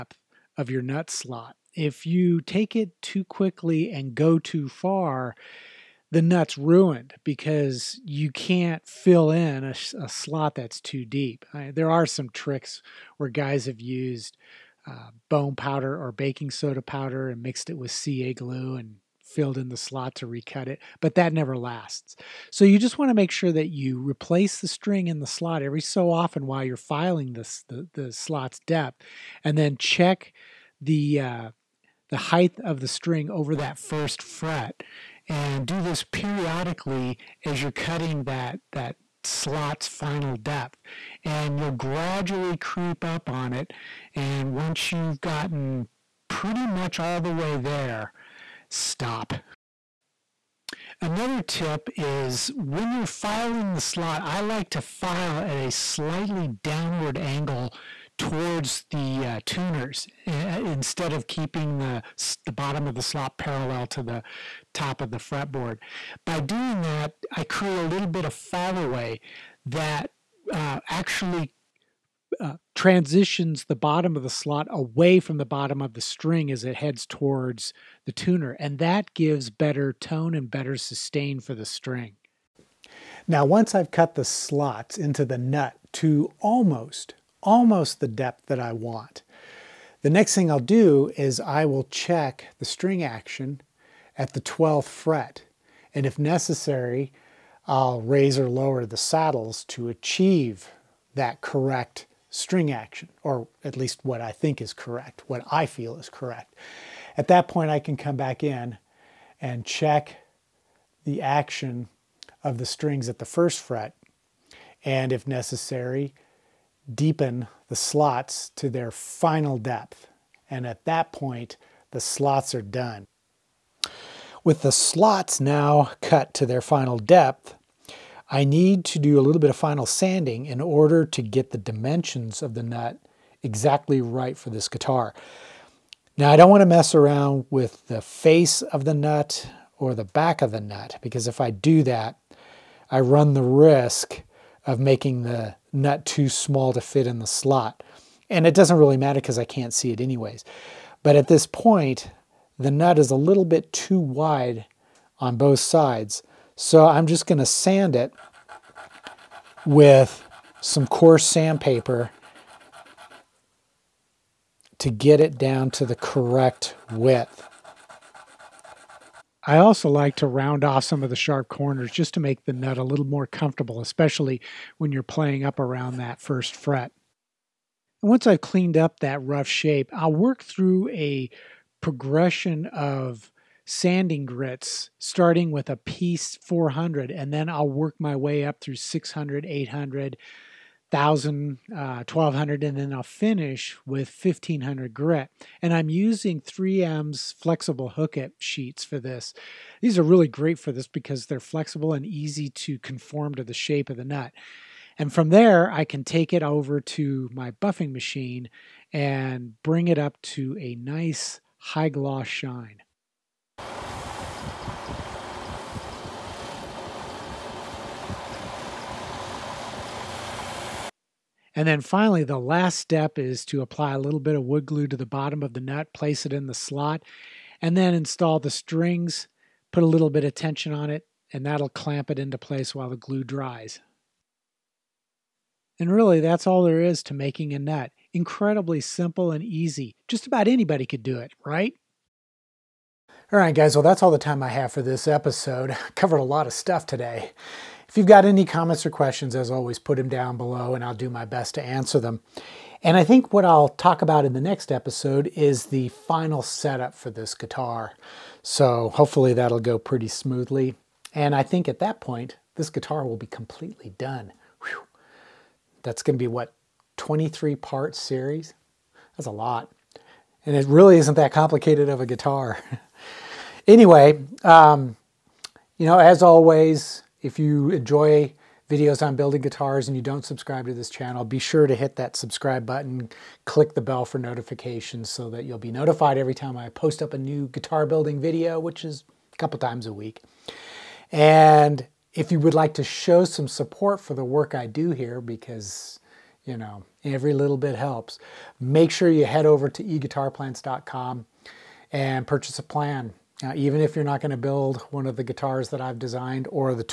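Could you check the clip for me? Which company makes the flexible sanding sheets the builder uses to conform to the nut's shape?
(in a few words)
3M.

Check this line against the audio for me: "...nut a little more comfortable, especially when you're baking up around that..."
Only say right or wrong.
wrong.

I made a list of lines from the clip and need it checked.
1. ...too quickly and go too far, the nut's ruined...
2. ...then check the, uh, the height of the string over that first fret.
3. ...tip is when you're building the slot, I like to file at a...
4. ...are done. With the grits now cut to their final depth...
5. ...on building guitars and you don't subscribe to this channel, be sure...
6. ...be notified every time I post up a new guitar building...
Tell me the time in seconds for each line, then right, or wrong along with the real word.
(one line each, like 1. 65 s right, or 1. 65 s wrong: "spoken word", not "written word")
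1. 2 s right
2. 29 s right
3. 51 s wrong: "filing", not "building"
4. 122 s wrong: "slots", not "grits"
5. 279 s right
6. 285 s right.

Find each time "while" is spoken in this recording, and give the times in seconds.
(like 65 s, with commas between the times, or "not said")
26 s, 232 s.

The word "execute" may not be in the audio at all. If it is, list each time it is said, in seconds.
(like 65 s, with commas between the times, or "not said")
not said.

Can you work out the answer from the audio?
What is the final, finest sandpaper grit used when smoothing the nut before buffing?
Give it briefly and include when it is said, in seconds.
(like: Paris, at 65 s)
1500, at 194 s.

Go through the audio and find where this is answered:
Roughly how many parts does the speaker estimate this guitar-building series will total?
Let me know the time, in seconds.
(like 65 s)
266 s.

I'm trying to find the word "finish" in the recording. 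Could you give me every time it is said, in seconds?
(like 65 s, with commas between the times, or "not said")
193 s.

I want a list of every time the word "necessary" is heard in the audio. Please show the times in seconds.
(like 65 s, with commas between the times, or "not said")
96 s, 115 s.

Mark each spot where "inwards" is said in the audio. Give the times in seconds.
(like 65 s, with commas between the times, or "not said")
not said.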